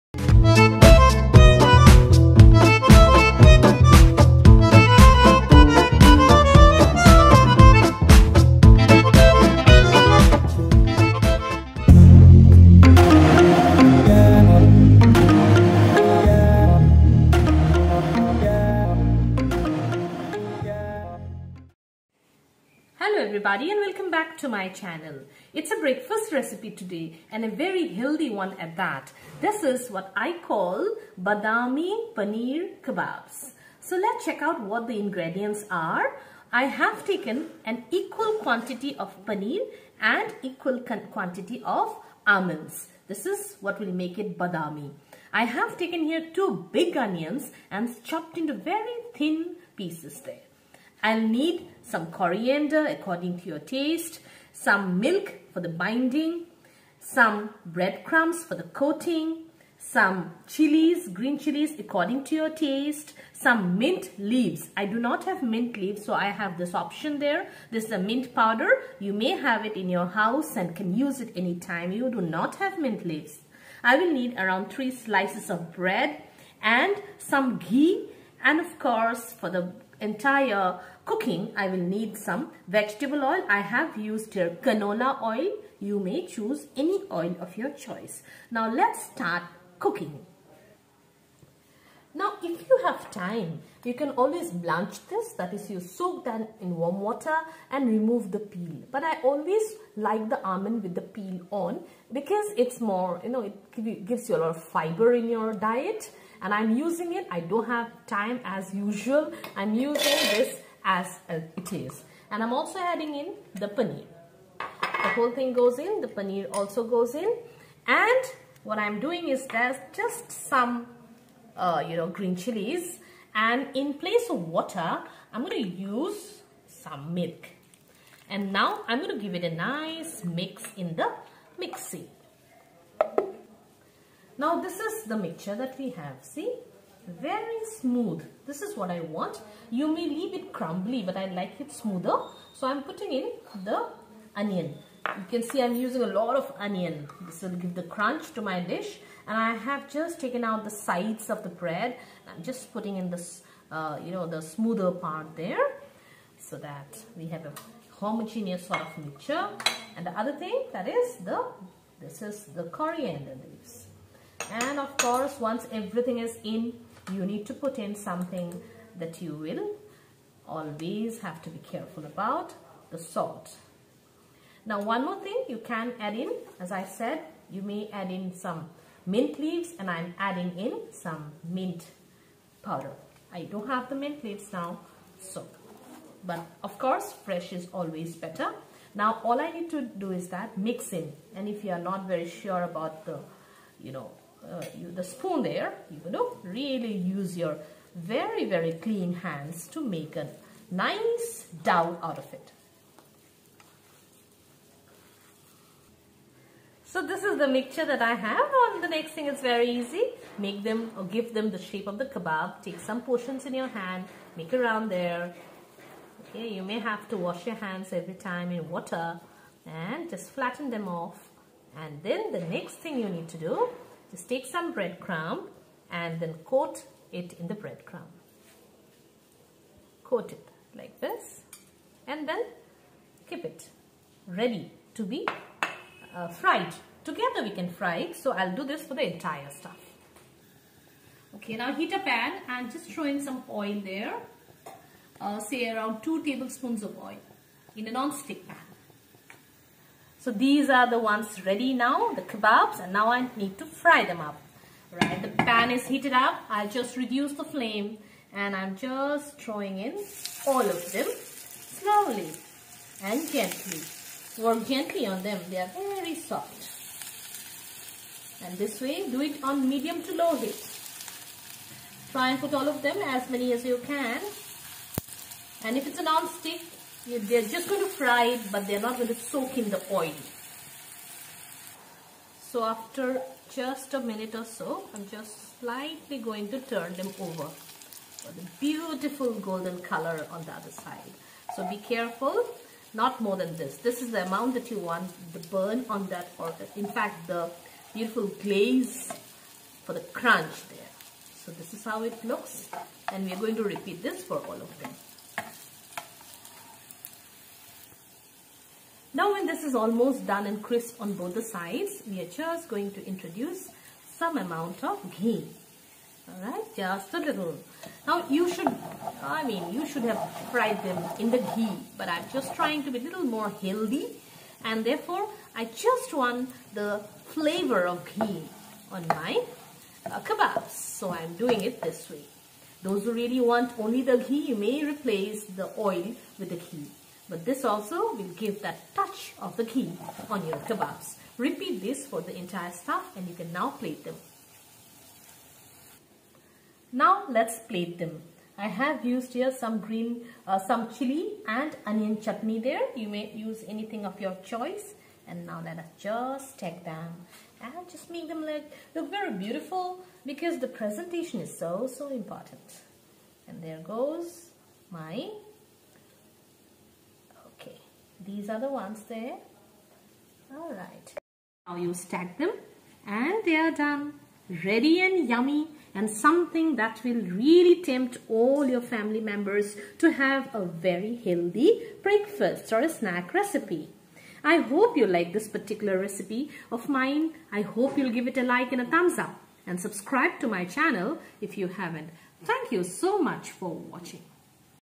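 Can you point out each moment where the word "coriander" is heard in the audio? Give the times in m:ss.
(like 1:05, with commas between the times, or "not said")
0:52, 2:42.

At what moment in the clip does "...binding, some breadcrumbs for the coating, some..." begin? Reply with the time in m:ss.
0:55.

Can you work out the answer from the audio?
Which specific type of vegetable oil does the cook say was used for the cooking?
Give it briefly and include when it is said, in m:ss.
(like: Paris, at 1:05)
canola oil, at 1:24.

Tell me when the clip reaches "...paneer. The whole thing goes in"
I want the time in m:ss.
1:53.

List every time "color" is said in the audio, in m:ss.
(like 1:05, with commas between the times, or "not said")
4:49.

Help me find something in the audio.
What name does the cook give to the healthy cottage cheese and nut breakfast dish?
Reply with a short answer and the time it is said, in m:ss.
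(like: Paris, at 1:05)
Badami Paneer Kebabs, at 0:31.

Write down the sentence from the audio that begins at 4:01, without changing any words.
Okay, now heat a pan and just throw in some oil there.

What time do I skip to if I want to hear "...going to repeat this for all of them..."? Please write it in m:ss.
5:03.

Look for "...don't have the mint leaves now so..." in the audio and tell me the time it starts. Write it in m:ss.
3:03.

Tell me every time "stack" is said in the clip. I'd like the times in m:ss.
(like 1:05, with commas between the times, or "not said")
6:12.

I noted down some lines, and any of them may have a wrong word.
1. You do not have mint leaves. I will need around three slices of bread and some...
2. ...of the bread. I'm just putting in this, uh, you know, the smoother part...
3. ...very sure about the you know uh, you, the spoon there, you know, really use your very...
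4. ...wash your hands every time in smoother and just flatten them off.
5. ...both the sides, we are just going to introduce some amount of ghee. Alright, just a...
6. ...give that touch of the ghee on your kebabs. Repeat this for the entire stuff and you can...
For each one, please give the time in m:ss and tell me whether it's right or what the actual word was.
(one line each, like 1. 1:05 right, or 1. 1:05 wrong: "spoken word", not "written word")
1. 1:11 right
2. 2:31 right
3. 3:12 right
4. 3:37 wrong: "water", not "smoother"
5. 5:11 right
6. 5:38 right.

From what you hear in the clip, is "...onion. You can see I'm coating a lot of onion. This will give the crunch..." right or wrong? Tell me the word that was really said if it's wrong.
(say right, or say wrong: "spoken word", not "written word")
wrong: "using", not "coating".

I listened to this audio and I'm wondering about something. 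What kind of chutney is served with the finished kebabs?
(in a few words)
chili and onion chutney.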